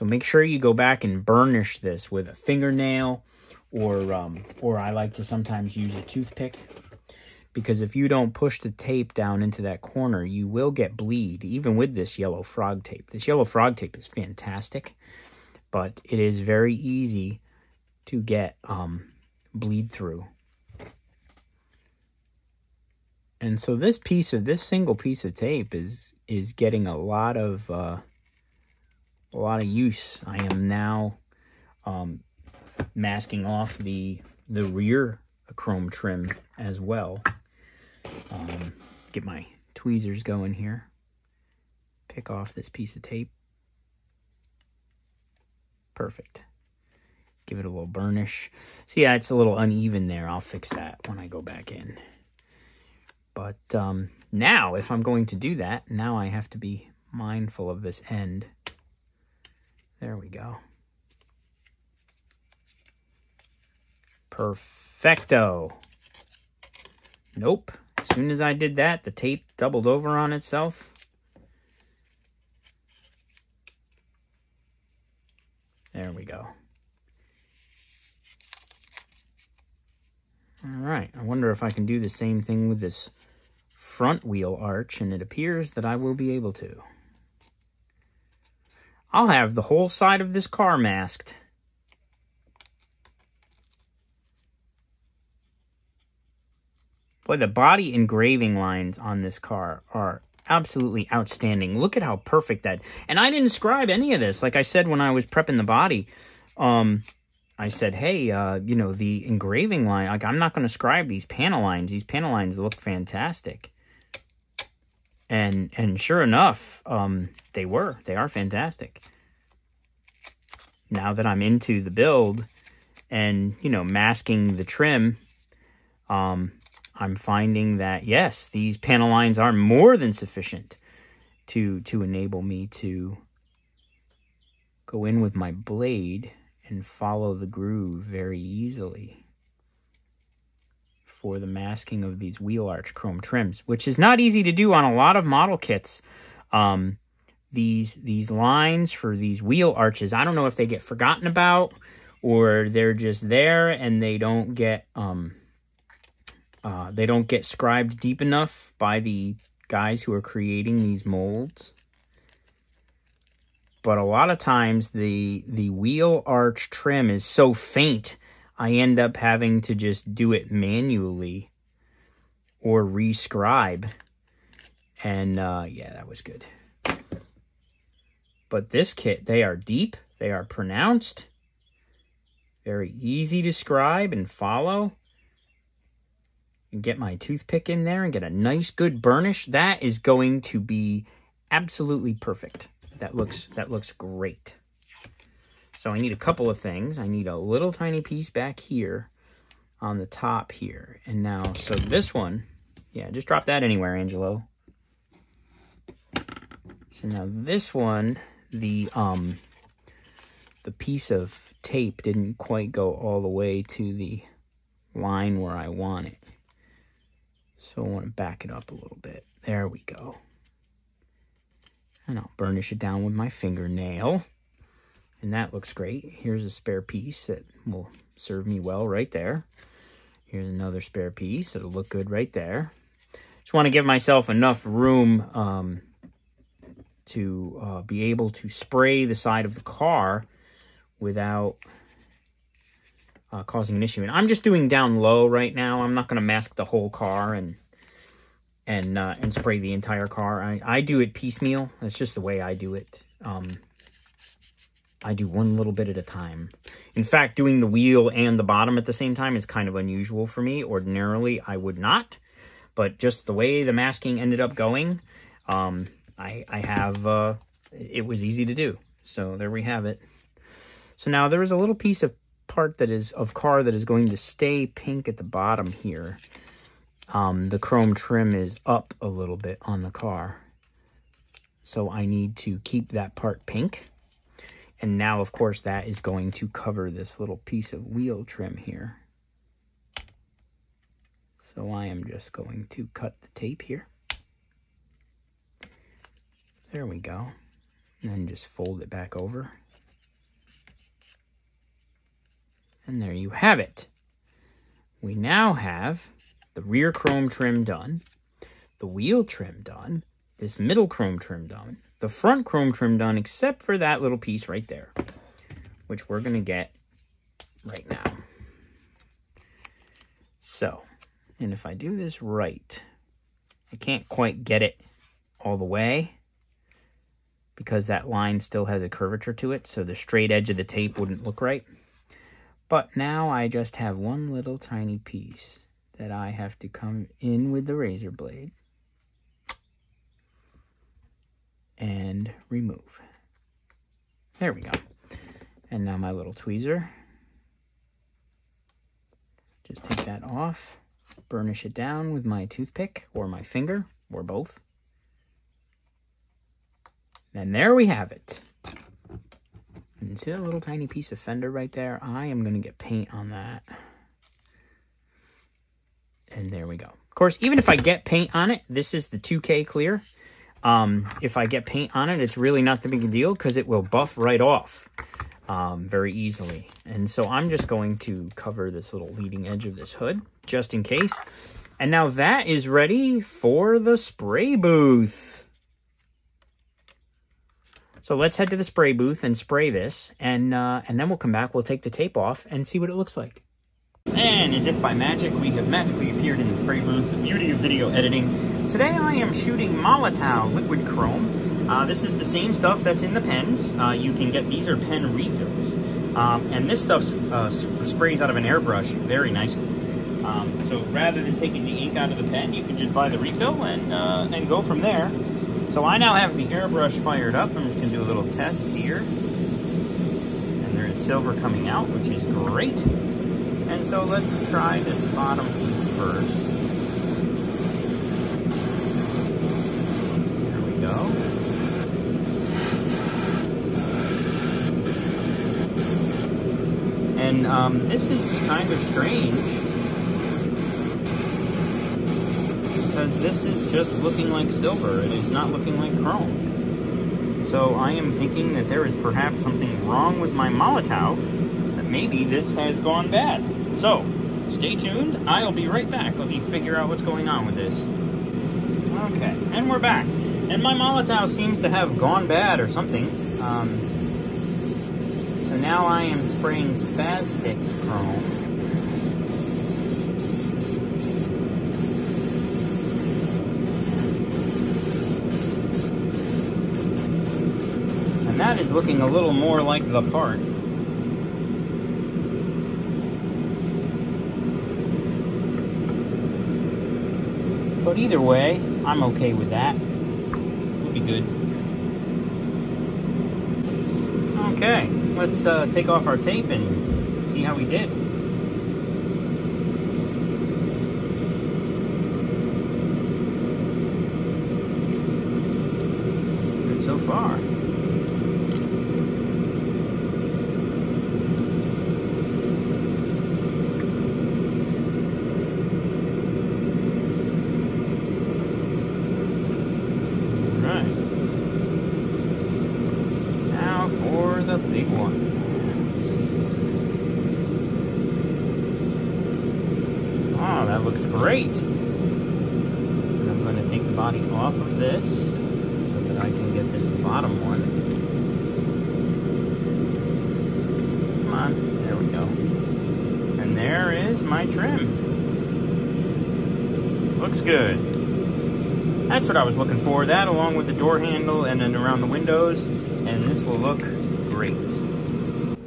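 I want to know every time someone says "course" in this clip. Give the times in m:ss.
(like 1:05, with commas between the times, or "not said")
4:45, 6:07.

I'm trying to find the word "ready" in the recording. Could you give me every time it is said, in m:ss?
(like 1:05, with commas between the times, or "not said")
6:22.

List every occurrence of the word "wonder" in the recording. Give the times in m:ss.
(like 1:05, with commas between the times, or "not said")
1:21.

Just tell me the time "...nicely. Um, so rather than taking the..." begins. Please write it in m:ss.
6:49.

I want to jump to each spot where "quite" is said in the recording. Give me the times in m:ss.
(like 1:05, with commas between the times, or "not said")
3:32, 5:24.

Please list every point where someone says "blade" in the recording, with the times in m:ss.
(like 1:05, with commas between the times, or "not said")
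2:15, 5:38.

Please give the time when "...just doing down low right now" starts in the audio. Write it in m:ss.
4:04.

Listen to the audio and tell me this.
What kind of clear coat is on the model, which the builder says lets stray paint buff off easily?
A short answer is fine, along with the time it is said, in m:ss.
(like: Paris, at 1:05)
2K clear, at 6:09.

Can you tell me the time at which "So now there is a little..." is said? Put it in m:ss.
4:30.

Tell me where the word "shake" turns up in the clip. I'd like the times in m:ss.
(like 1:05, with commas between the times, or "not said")
not said.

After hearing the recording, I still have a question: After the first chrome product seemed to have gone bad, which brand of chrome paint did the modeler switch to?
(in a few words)
Spaz Stix.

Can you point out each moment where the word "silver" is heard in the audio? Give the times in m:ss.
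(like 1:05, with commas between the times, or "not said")
7:00, 7:24.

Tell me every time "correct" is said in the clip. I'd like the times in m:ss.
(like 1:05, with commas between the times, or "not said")
not said.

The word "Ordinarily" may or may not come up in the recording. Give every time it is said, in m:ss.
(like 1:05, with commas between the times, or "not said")
4:20.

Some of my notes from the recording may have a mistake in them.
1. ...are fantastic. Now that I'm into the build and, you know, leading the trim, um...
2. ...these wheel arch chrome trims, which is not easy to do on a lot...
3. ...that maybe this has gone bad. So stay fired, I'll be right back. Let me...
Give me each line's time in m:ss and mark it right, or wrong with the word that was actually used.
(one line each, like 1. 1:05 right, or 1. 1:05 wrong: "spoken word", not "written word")
1. 1:58 wrong: "masking", not "leading"
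2. 2:22 right
3. 7:31 wrong: "tuned", not "fired".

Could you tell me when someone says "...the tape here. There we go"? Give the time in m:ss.
4:53.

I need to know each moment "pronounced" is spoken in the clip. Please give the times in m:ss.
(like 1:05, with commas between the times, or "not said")
3:00.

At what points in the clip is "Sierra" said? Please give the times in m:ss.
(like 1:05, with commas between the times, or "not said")
not said.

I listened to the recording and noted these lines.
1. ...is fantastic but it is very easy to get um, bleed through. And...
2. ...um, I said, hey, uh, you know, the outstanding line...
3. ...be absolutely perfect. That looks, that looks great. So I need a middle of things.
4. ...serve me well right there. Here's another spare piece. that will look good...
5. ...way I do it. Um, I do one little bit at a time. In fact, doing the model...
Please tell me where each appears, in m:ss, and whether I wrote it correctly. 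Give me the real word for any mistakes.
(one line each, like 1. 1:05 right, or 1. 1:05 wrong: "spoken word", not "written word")
1. 0:13 right
2. 1:46 wrong: "engraving", not "outstanding"
3. 3:10 wrong: "couple", not "middle"
4. 3:48 right
5. 4:12 wrong: "wheel", not "model".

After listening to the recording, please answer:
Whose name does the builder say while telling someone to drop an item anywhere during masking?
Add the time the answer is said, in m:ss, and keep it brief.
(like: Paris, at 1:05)
Angelo, at 3:23.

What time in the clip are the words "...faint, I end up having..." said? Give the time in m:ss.
2:47.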